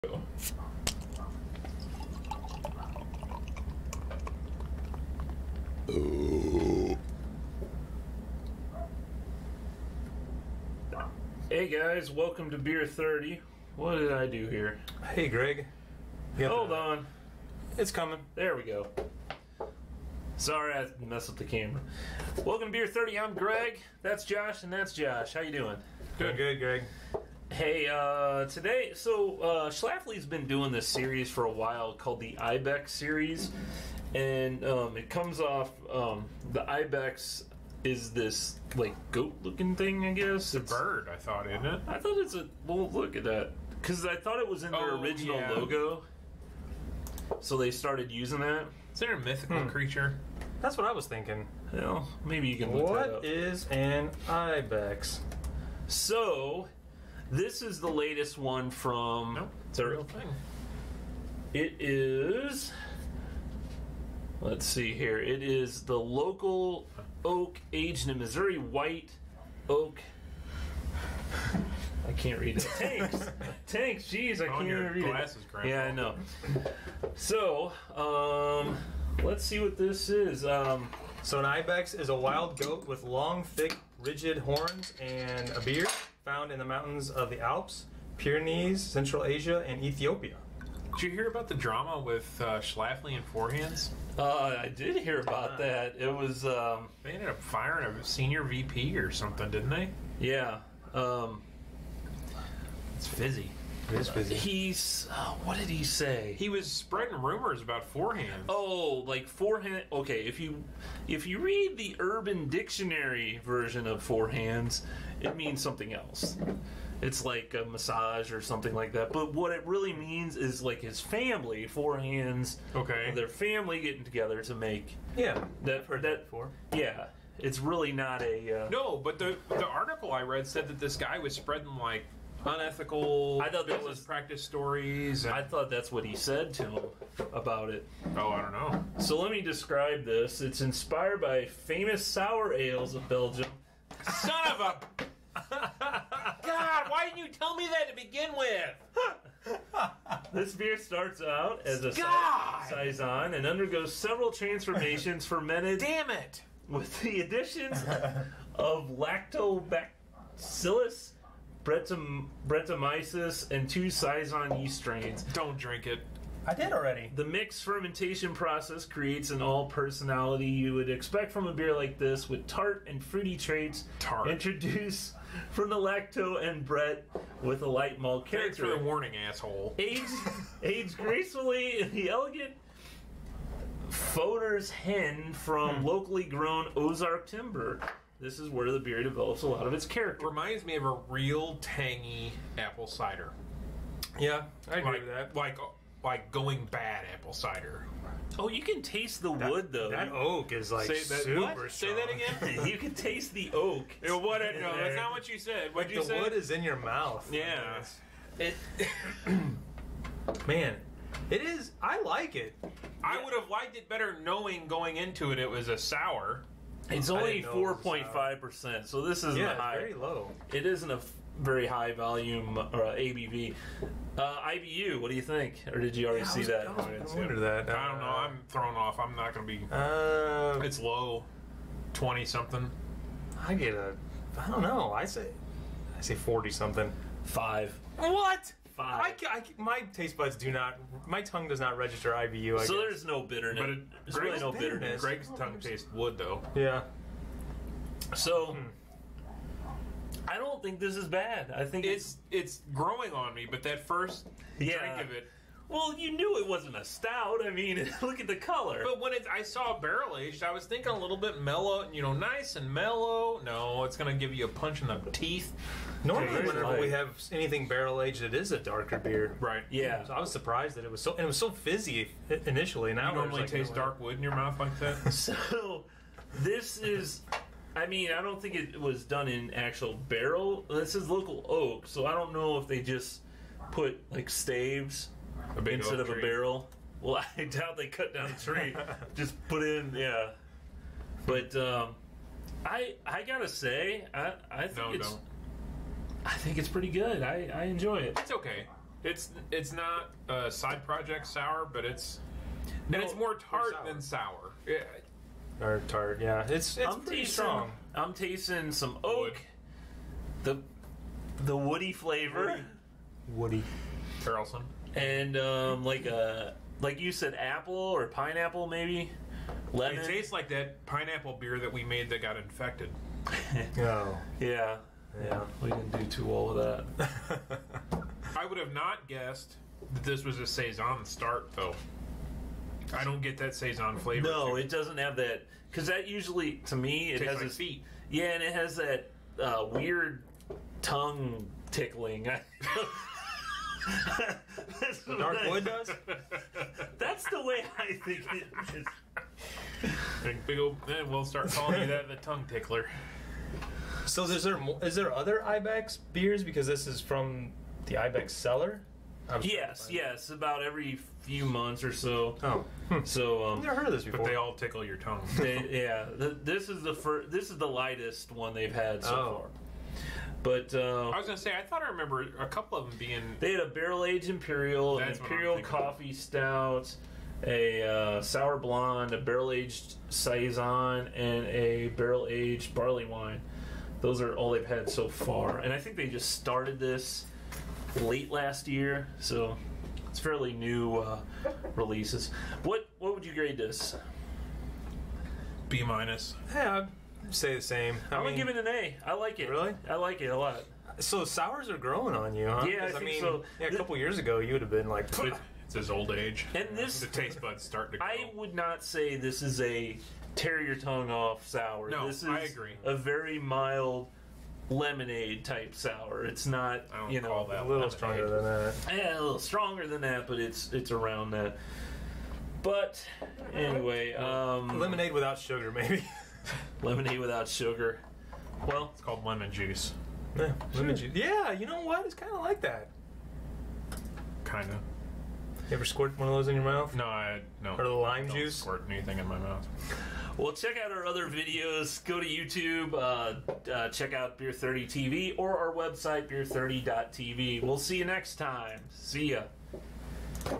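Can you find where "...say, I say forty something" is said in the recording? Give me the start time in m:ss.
3:55.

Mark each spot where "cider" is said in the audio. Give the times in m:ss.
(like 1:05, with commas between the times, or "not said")
3:12, 3:17.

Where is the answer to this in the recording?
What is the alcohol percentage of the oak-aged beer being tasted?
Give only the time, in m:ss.
3:37.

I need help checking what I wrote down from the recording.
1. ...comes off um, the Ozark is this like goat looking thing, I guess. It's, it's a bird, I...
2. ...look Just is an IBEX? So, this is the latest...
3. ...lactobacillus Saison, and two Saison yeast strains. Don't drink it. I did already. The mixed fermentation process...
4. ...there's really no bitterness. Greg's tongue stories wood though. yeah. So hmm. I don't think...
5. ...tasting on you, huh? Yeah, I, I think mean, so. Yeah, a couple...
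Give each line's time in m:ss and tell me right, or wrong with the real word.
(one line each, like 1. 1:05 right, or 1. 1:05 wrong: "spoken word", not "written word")
1. 0:35 wrong: "IBEX", not "Ozark"
2. 0:52 wrong: "What", not "Just"
3. 2:38 wrong: "Brettanomyces", not "Saison"
4. 4:04 wrong: "tastes", not "stories"
5. 6:41 wrong: "growing", not "tasting".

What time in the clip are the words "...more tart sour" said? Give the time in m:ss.
5:03.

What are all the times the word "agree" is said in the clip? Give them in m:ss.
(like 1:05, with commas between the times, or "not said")
3:14, 6:52.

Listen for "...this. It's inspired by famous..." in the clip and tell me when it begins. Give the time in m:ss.
2:20.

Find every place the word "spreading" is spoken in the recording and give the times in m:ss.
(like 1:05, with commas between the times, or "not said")
1:46, 2:11.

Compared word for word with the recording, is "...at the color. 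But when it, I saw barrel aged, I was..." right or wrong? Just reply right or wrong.
right.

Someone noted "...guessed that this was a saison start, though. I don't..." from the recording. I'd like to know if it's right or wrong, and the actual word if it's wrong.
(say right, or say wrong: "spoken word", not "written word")
right.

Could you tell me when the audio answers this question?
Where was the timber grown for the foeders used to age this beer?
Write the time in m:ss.
3:06.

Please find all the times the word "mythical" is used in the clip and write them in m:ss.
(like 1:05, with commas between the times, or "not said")
0:49.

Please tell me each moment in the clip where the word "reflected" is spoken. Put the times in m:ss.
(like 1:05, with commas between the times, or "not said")
not said.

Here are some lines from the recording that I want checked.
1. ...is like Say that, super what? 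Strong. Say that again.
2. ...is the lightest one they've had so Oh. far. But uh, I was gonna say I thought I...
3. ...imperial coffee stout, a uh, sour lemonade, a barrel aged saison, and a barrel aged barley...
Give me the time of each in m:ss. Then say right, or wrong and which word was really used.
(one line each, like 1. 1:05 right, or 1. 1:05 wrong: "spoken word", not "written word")
1. 3:20 right
2. 6:07 right
3. 6:15 wrong: "blonde", not "lemonade".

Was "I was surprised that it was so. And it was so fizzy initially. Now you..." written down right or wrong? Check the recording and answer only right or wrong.
right.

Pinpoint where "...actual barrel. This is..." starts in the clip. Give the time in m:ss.
4:39.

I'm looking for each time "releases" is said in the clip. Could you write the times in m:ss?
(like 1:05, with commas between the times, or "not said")
6:31.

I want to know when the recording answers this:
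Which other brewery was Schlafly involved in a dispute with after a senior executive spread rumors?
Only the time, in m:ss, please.
1:33.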